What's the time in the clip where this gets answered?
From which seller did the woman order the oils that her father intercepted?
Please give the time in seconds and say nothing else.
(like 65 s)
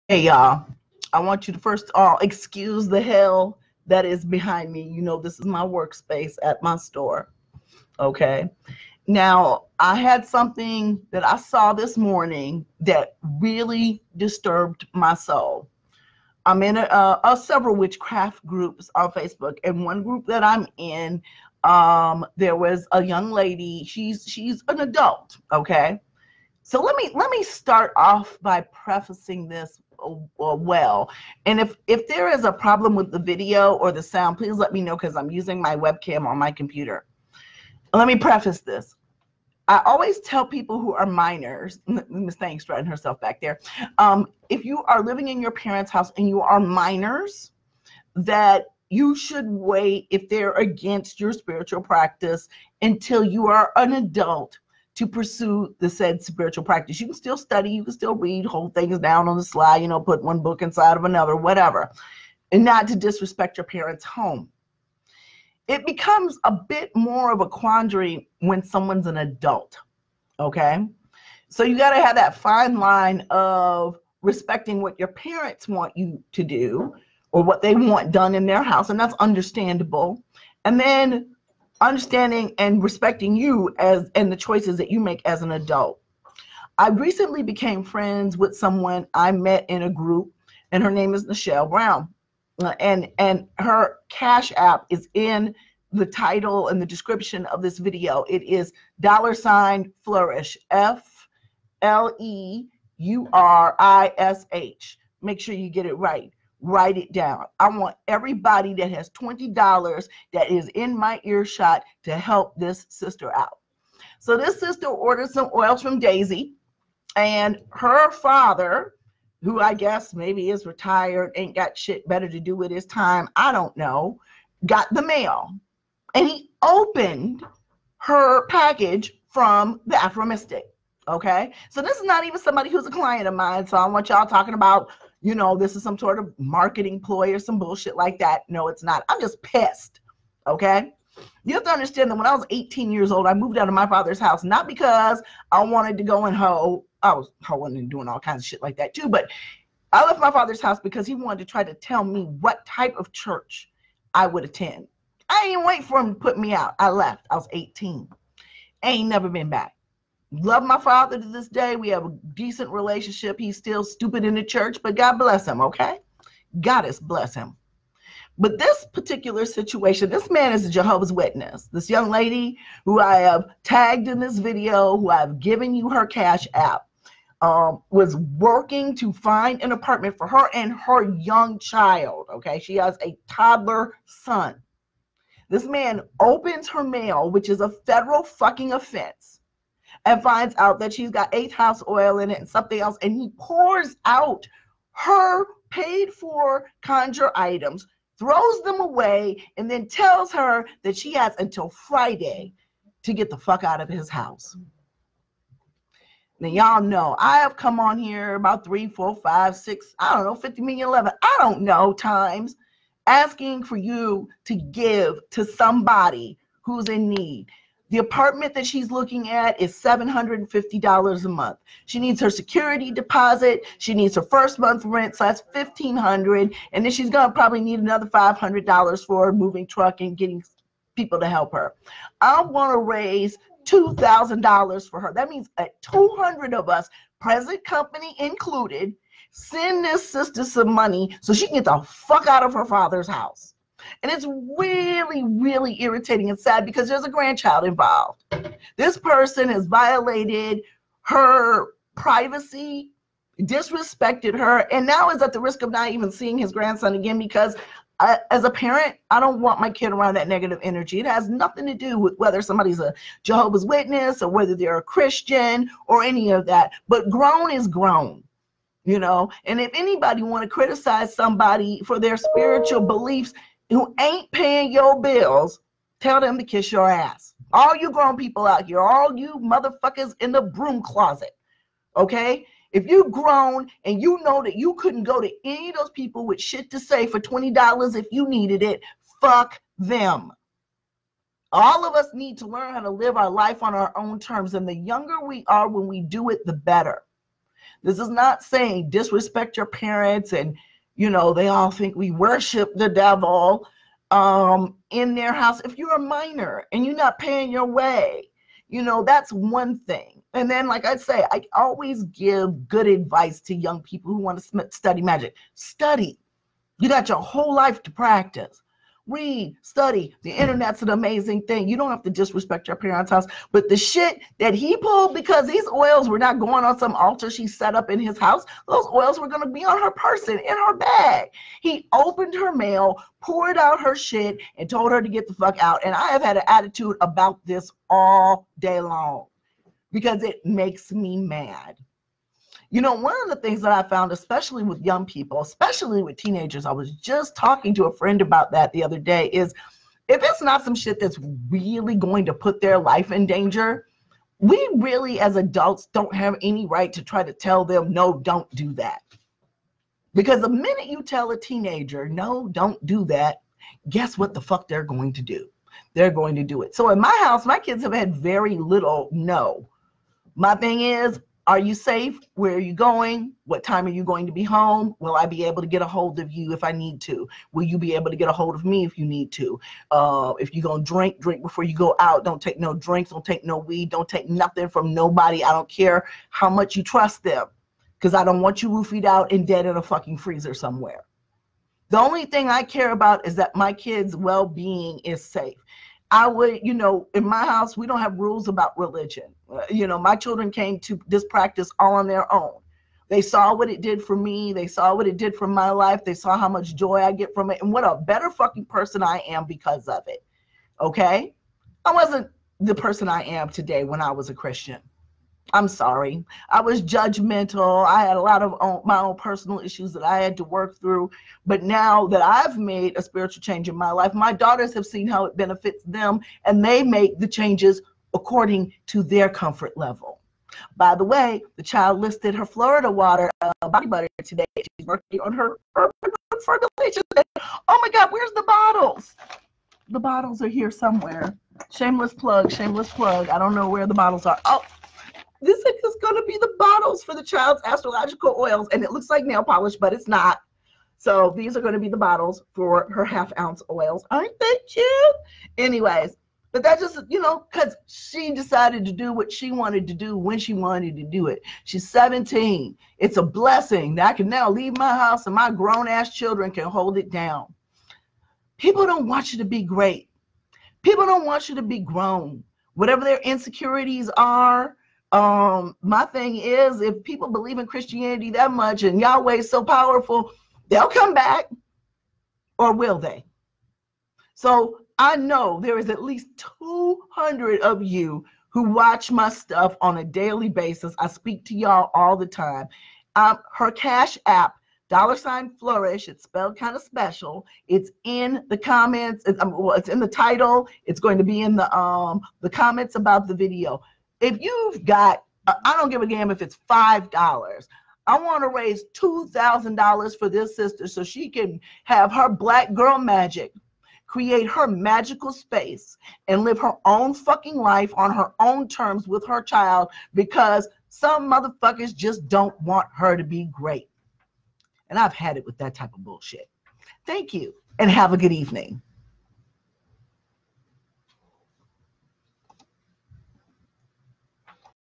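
129 s.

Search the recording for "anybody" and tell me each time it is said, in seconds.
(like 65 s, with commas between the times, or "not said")
269 s.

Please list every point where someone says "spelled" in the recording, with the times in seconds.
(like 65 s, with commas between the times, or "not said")
496 s.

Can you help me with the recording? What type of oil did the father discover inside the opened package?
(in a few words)
eighth house oil.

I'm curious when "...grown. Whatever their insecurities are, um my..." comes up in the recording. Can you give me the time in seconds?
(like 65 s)
471 s.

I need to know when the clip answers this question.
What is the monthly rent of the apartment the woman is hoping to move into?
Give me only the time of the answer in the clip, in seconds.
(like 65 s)
219 s.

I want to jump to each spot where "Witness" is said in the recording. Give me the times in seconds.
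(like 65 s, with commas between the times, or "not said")
171 s, 263 s.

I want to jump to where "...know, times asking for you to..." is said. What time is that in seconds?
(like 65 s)
211 s.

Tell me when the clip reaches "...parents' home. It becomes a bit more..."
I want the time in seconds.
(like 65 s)
63 s.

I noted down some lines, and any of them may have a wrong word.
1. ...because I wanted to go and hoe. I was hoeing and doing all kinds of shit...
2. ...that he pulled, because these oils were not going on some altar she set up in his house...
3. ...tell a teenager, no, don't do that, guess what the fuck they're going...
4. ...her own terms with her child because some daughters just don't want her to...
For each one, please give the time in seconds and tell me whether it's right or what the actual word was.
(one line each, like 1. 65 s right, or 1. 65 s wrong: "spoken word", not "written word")
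1. 144 s right
2. 324 s right
3. 361 s right
4. 518 s wrong: "motherfuckers", not "daughters".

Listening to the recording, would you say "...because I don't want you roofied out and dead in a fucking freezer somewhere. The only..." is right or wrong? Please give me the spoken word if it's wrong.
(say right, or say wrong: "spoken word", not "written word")
right.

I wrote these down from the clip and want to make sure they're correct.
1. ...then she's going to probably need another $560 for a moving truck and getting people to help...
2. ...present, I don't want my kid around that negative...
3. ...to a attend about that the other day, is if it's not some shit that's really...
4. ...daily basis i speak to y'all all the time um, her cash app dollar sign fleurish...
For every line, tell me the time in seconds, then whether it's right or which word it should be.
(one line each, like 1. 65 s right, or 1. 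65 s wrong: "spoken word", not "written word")
1. 226 s wrong: "500", not "560"
2. 258 s wrong: "parent", not "present"
3. 347 s wrong: "friend", not "attend"
4. 490 s right.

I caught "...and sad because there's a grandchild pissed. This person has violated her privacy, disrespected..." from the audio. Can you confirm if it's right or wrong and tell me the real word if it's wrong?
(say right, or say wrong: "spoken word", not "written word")
wrong: "involved", not "pissed".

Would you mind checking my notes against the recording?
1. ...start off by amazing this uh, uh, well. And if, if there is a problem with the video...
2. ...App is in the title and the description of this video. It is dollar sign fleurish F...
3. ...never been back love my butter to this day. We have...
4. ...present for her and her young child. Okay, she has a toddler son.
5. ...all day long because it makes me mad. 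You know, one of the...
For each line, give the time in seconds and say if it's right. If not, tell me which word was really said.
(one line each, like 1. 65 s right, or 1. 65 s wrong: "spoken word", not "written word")
1. 27 s wrong: "prefacing", not "amazing"
2. 94 s right
3. 159 s wrong: "father", not "butter"
4. 179 s wrong: "apartment", not "present"
5. 337 s right.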